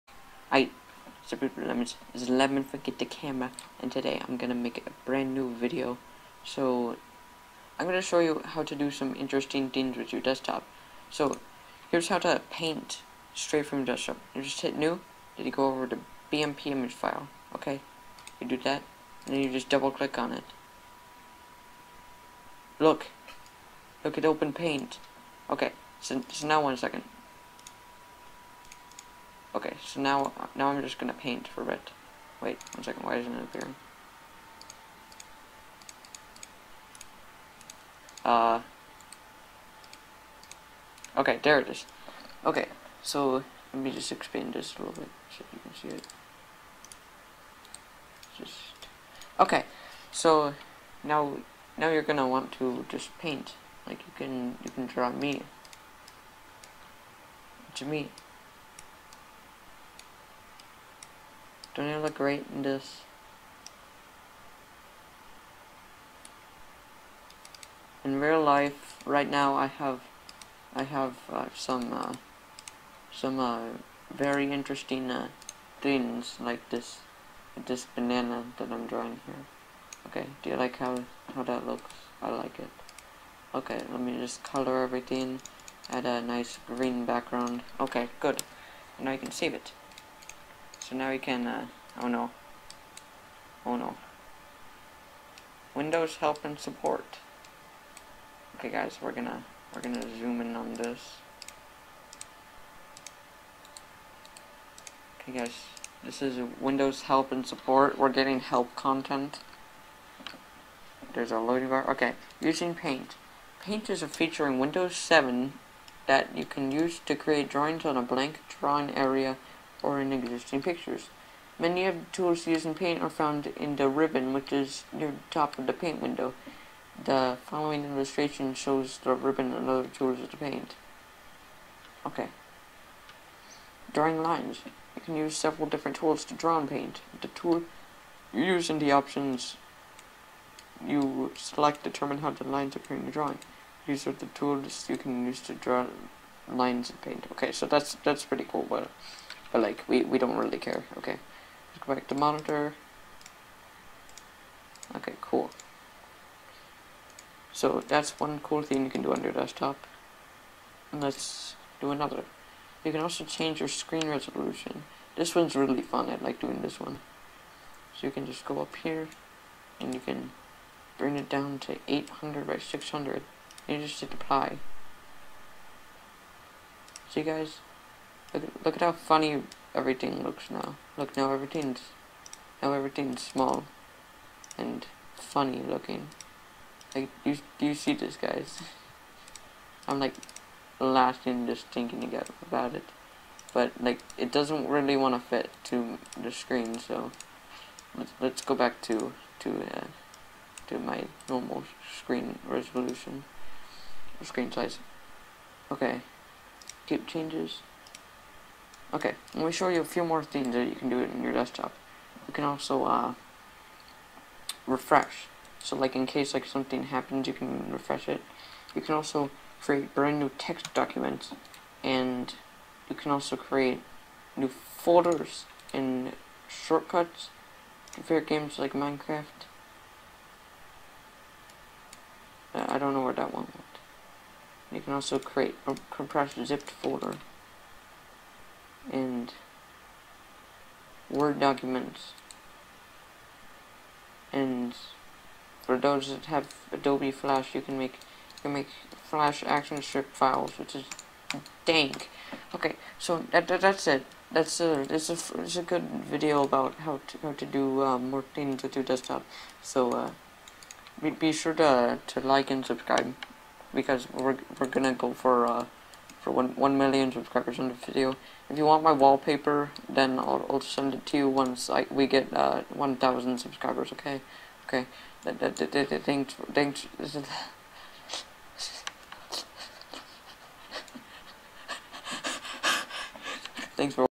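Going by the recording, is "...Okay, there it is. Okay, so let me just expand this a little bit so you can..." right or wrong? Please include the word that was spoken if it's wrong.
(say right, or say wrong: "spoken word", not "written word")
right.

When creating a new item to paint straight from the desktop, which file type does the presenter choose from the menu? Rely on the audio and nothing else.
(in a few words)
BMP image file.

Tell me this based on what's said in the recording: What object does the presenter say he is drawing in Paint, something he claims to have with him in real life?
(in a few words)
banana.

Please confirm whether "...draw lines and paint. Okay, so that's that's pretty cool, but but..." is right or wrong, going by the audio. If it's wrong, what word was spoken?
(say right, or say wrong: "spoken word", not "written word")
right.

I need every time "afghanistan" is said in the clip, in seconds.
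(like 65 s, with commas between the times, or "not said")
not said.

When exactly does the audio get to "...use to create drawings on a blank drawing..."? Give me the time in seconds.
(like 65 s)
116 s.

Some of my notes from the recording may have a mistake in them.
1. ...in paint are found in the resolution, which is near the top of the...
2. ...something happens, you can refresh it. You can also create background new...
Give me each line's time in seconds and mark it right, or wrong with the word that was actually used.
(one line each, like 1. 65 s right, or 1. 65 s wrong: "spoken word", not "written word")
1. 122 s wrong: "ribbon", not "resolution"
2. 216 s wrong: "brand", not "background".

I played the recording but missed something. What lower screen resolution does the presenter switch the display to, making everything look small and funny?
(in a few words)
800 by 600.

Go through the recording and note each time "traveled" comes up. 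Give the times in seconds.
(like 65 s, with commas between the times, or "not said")
not said.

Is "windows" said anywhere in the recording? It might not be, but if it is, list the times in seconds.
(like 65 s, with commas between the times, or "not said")
95 s, 106 s, 114 s, 126 s.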